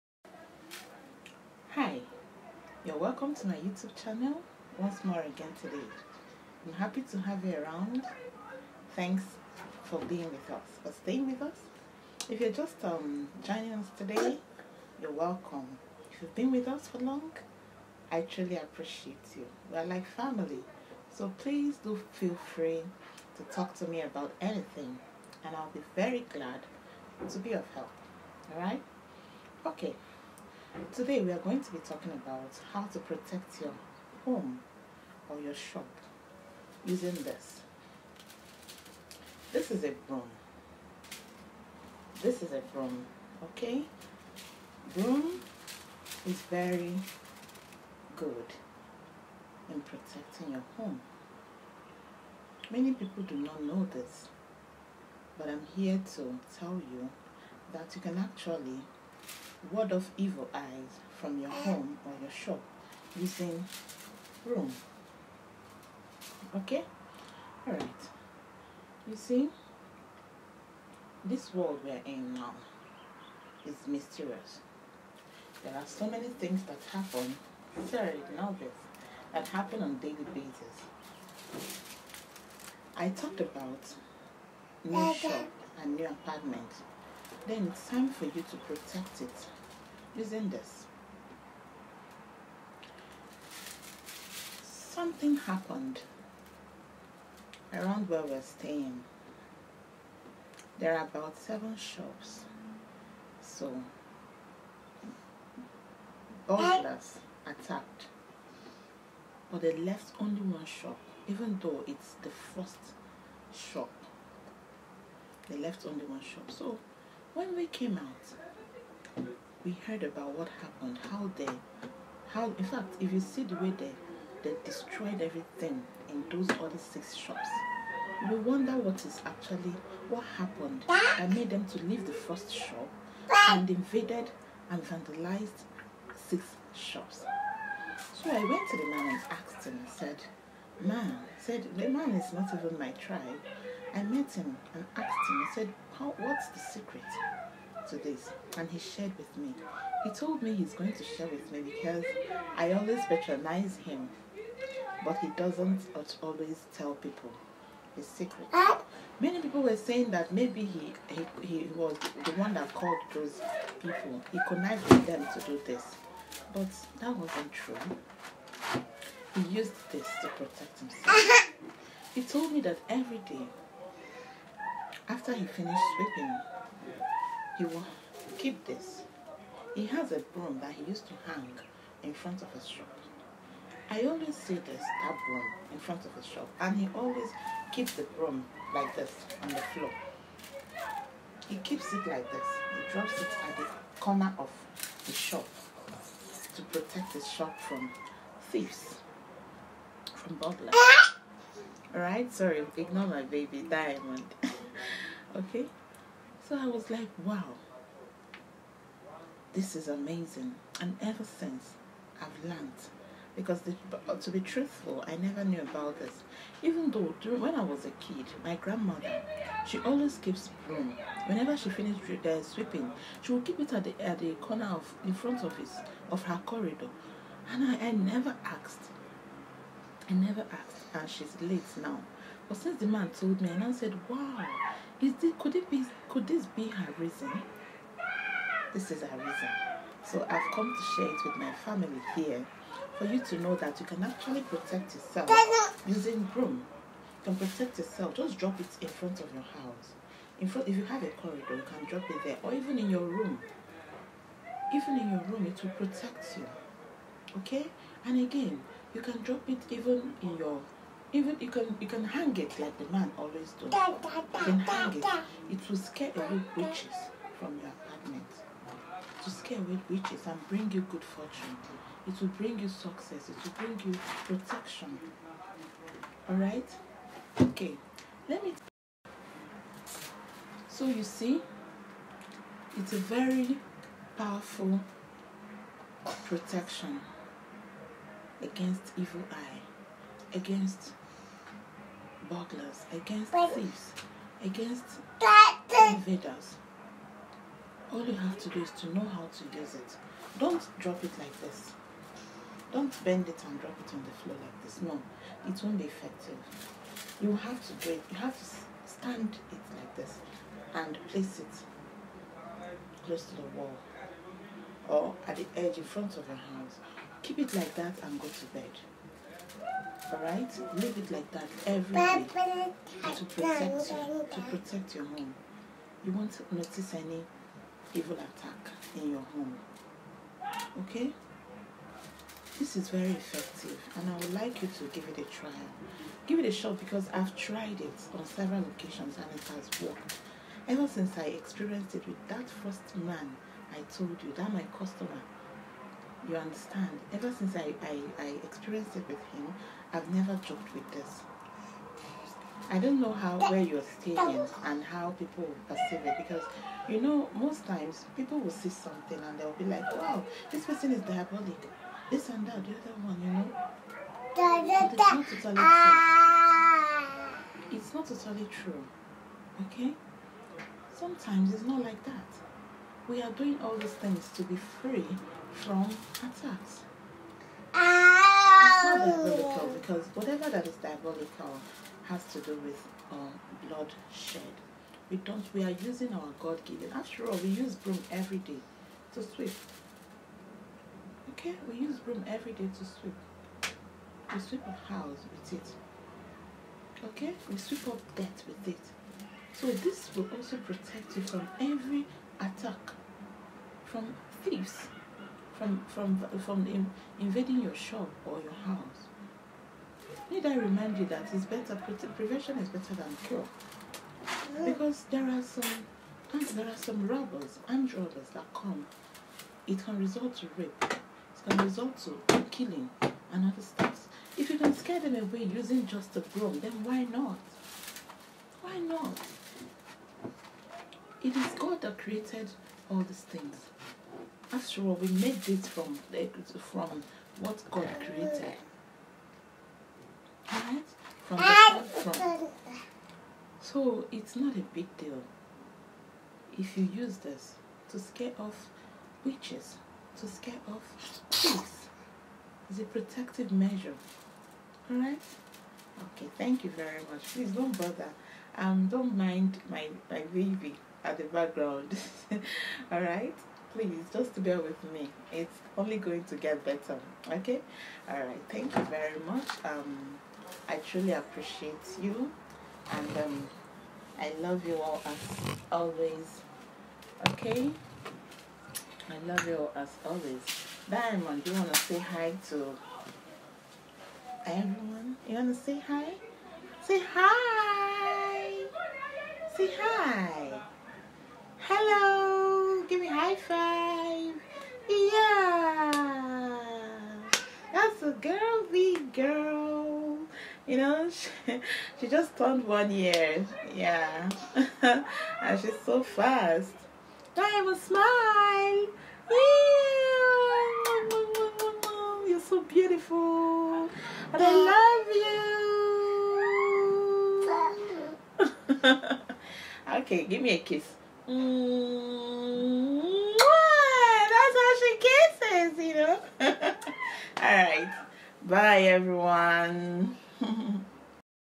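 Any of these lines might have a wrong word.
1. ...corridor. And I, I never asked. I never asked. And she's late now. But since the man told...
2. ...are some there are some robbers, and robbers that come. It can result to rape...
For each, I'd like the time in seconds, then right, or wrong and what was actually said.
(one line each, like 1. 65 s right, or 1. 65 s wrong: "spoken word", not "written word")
1. 226 s right
2. 415 s right.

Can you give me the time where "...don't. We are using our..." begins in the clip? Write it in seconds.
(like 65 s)
385 s.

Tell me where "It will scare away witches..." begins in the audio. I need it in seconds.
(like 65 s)
265 s.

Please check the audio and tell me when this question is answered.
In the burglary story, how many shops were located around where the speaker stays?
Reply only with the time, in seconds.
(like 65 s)
101 s.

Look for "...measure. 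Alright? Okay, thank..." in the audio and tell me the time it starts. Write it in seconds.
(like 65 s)
453 s.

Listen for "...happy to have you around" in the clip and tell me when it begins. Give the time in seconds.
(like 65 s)
6 s.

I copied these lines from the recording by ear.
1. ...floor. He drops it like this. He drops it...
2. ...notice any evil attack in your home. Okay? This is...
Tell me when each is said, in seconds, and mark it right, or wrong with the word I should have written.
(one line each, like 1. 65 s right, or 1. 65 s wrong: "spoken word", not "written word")
1. 189 s wrong: "keeps", not "drops"
2. 326 s right.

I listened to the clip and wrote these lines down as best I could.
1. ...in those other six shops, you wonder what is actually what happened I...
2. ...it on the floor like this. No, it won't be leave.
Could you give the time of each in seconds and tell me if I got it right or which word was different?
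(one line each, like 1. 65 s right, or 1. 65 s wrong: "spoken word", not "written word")
1. 126 s right
2. 303 s wrong: "effective", not "leave".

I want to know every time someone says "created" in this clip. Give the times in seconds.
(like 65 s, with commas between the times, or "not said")
431 s, 437 s.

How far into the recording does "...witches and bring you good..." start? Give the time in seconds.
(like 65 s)
269 s.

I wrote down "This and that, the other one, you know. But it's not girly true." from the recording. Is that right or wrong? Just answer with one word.
wrong.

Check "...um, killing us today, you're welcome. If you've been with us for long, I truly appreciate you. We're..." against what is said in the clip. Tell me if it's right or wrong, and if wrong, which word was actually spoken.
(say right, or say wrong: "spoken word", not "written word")
wrong: "joining", not "killing".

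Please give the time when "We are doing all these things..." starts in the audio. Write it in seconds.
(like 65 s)
373 s.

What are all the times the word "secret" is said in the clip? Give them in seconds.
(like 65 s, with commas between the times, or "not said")
146 s, 158 s.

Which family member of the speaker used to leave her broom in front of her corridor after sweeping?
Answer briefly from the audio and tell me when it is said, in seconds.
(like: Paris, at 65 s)
Grandmother, at 218 s.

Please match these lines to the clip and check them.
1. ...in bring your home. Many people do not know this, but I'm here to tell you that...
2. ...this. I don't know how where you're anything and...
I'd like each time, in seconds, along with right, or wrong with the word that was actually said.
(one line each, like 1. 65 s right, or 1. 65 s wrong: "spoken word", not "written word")
1. 49 s wrong: "protecting", not "bring"
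2. 350 s wrong: "staying", not "anything".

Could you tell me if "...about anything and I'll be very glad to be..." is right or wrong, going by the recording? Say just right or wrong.
right.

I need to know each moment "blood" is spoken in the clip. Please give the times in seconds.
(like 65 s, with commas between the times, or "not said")
383 s.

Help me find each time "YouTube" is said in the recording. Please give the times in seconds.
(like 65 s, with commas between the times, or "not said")
3 s.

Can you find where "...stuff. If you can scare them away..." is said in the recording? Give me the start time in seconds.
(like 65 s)
423 s.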